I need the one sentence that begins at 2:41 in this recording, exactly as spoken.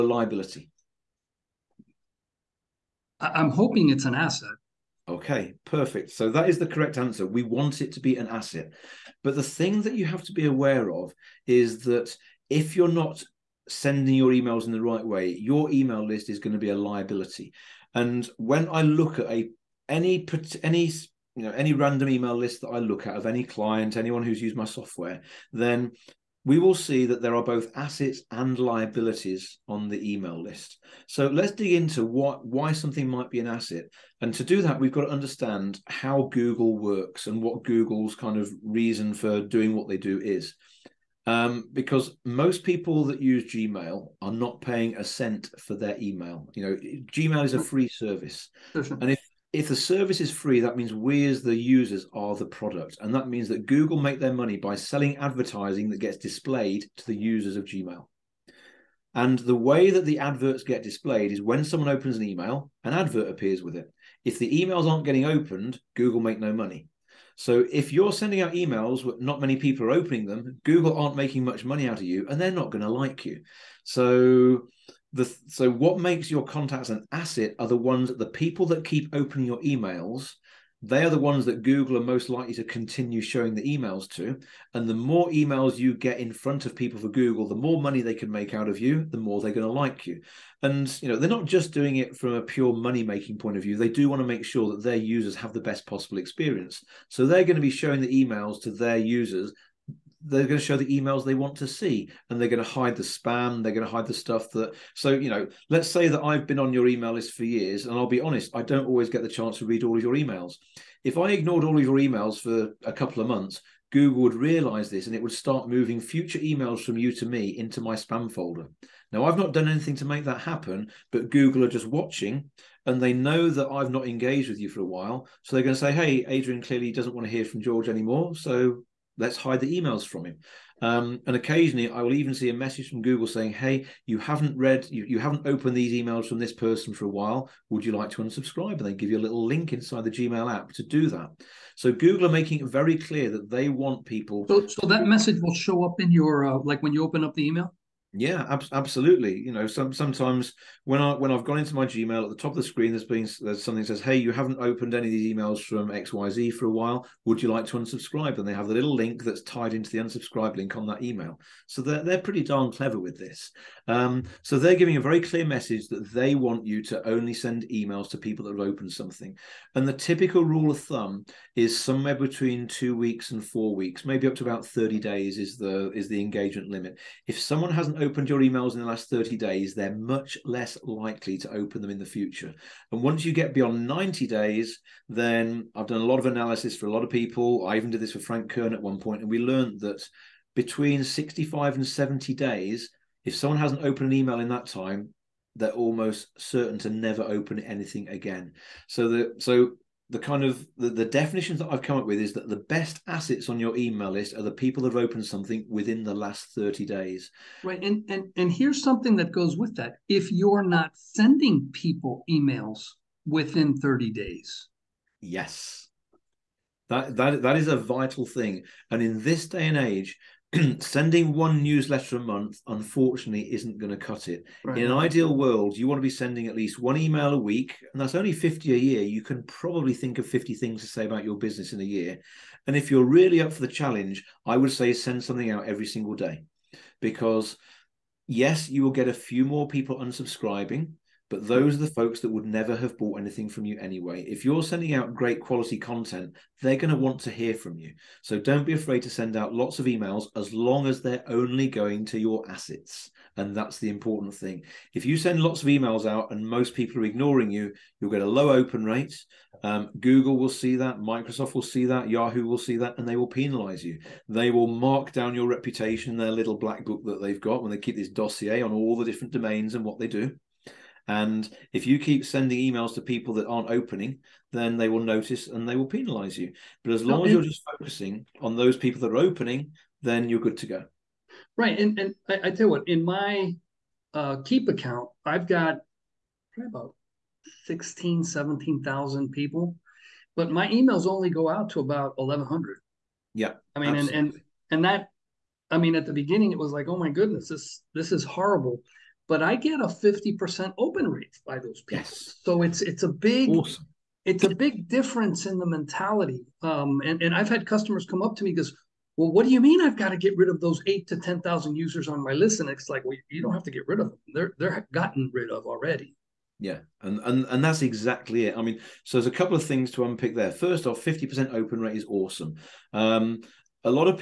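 So they're they're pretty darn clever with this.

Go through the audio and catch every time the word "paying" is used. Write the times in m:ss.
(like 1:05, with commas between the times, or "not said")
0:44.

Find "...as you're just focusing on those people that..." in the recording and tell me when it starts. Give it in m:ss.
4:37.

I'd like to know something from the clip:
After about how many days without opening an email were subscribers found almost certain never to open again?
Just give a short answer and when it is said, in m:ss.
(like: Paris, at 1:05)
65 to 70 days, at 3:10.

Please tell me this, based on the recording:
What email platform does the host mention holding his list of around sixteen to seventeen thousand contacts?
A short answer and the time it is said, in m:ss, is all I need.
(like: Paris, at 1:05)
Keap, at 4:44.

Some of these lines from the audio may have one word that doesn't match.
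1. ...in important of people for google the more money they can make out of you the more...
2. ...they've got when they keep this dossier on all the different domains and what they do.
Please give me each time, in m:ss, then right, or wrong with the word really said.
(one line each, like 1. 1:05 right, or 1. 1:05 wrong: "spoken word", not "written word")
1. 1:26 wrong: "front", not "important"
2. 4:27 right.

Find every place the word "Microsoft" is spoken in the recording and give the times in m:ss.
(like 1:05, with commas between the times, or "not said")
4:20.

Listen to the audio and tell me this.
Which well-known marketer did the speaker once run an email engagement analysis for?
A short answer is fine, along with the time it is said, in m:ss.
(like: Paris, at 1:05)
Frank Kern, at 3:08.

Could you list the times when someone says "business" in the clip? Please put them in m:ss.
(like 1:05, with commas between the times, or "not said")
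3:51.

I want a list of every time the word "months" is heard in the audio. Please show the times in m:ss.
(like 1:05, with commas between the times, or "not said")
1:53, 3:42.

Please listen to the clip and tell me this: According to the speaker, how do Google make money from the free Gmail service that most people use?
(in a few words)
Selling advertising.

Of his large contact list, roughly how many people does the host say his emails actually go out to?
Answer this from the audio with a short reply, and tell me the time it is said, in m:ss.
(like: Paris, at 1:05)
1,100, at 4:52.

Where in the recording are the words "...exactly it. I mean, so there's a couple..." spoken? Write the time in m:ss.
5:17.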